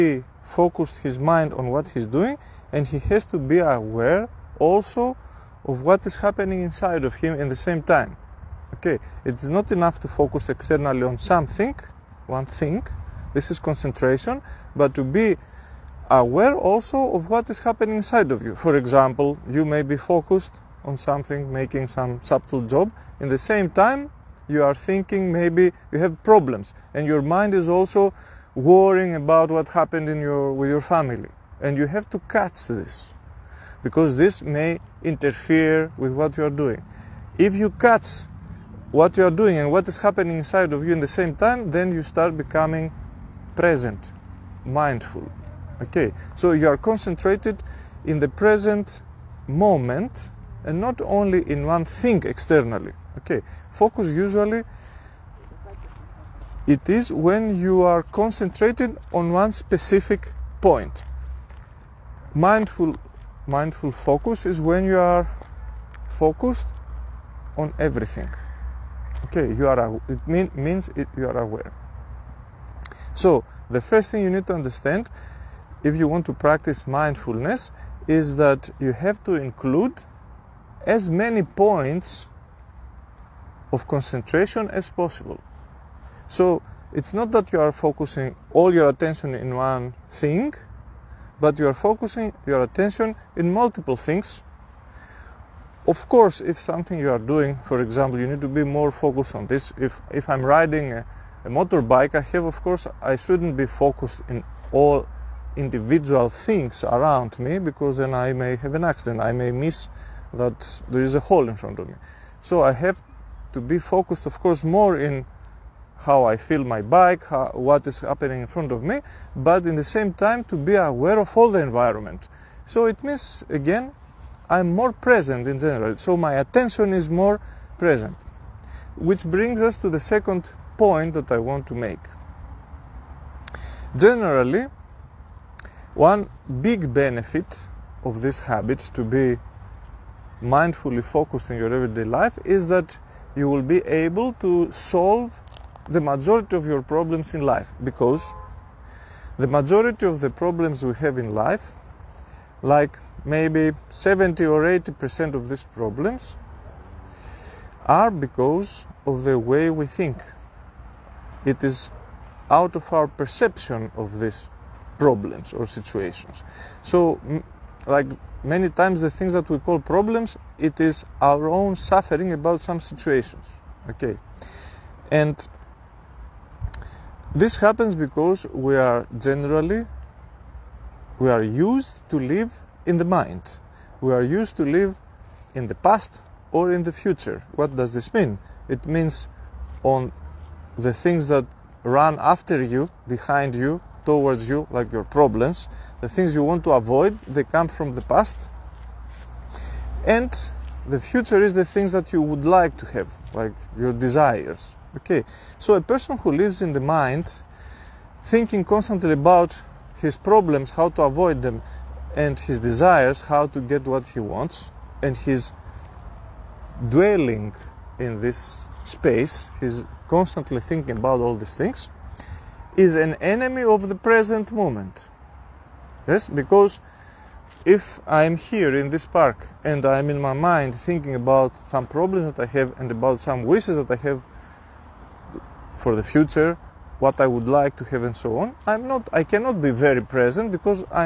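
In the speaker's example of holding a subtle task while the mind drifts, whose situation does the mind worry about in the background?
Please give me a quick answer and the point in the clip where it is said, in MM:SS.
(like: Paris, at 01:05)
Family, at 00:30.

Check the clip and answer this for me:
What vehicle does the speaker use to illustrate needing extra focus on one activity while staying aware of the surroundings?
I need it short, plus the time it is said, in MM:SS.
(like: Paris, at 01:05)
Motorbike, at 01:41.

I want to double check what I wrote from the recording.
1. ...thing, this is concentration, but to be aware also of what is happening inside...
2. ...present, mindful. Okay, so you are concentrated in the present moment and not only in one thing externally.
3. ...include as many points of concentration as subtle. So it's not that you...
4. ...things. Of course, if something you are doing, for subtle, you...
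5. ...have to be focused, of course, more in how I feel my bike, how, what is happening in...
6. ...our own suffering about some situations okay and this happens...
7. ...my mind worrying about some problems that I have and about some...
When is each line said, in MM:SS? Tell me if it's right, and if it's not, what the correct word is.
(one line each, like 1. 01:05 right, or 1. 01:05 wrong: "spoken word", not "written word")
1. 00:12 right
2. 00:43 right
3. 01:19 wrong: "possible", not "subtle"
4. 01:33 wrong: "example", not "subtle"
5. 01:52 right
6. 02:51 right
7. 03:50 wrong: "thinking", not "worrying".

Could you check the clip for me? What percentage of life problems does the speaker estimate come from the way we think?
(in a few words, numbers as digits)
70 or 80 percent.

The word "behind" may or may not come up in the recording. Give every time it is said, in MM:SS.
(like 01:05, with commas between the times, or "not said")
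03:13.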